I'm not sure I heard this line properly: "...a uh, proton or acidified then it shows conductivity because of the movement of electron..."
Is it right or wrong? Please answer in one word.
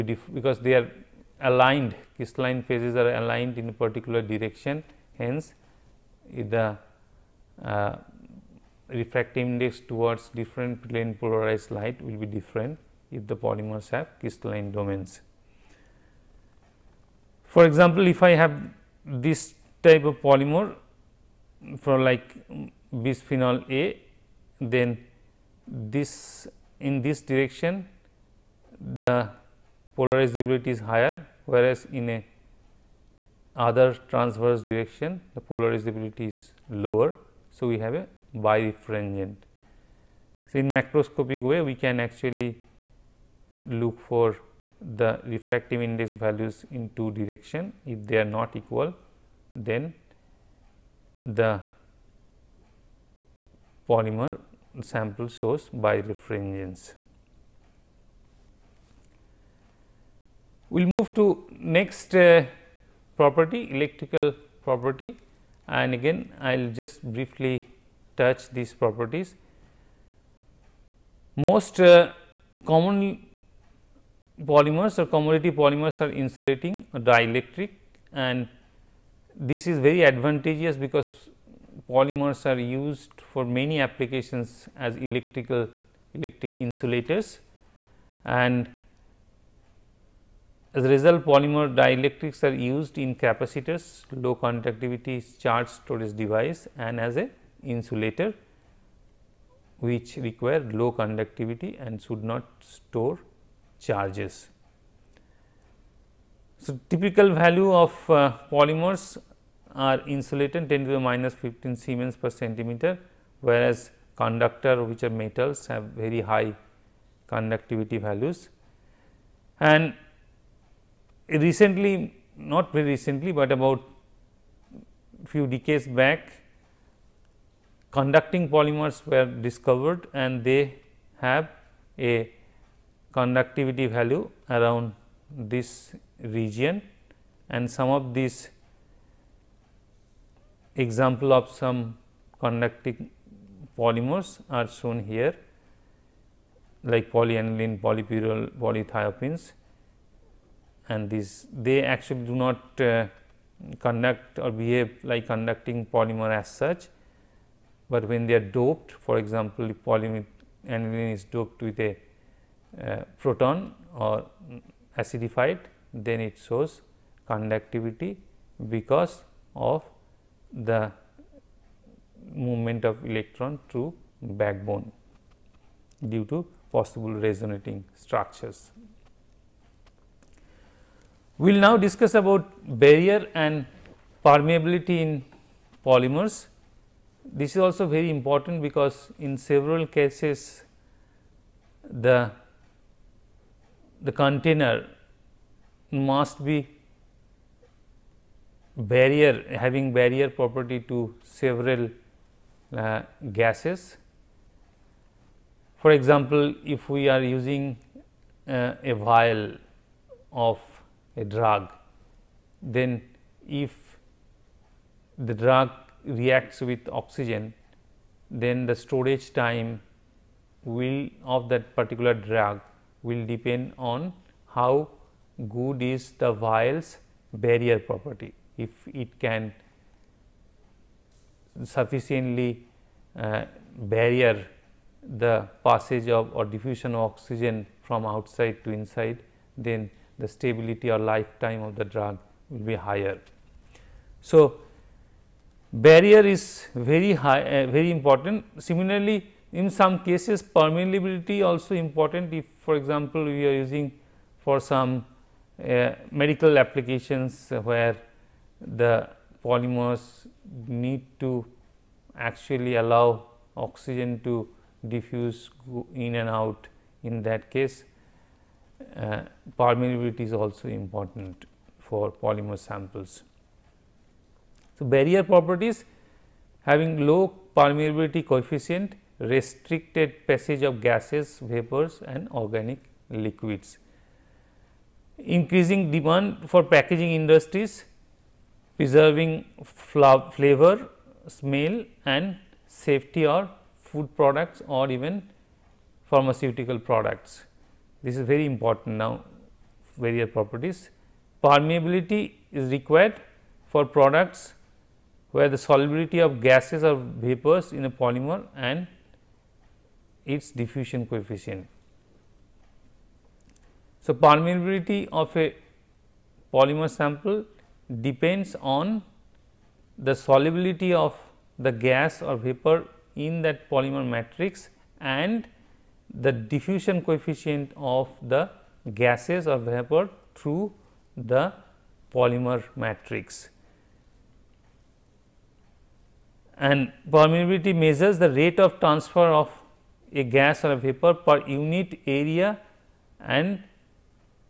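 right.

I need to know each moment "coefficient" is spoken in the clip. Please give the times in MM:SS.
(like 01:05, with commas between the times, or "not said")
04:38, 05:11, 05:27.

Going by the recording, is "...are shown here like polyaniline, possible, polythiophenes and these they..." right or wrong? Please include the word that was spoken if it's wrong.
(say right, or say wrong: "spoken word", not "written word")
wrong: "polypyrrole", not "possible".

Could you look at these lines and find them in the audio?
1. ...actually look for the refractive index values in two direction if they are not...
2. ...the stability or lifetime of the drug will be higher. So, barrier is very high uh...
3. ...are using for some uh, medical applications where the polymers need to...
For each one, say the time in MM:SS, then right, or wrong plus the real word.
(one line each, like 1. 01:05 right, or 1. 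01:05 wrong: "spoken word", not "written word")
1. 00:41 right
2. 04:00 right
3. 04:13 right.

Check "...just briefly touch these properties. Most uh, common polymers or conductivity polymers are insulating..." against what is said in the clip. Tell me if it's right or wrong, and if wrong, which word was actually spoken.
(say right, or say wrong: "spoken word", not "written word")
wrong: "commodity", not "conductivity".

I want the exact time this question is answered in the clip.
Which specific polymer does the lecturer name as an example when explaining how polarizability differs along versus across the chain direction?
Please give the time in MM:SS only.
00:23.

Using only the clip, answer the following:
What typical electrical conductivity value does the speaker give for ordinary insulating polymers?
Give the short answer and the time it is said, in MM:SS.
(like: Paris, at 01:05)
10^-15 S/cm, at 01:50.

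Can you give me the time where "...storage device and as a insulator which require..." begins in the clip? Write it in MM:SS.
01:35.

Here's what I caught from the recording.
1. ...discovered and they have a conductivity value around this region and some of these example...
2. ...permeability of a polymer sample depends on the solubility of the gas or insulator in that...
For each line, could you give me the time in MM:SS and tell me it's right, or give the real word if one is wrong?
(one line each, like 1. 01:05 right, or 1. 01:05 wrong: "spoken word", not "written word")
1. 02:09 right
2. 05:14 wrong: "vapor", not "insulator".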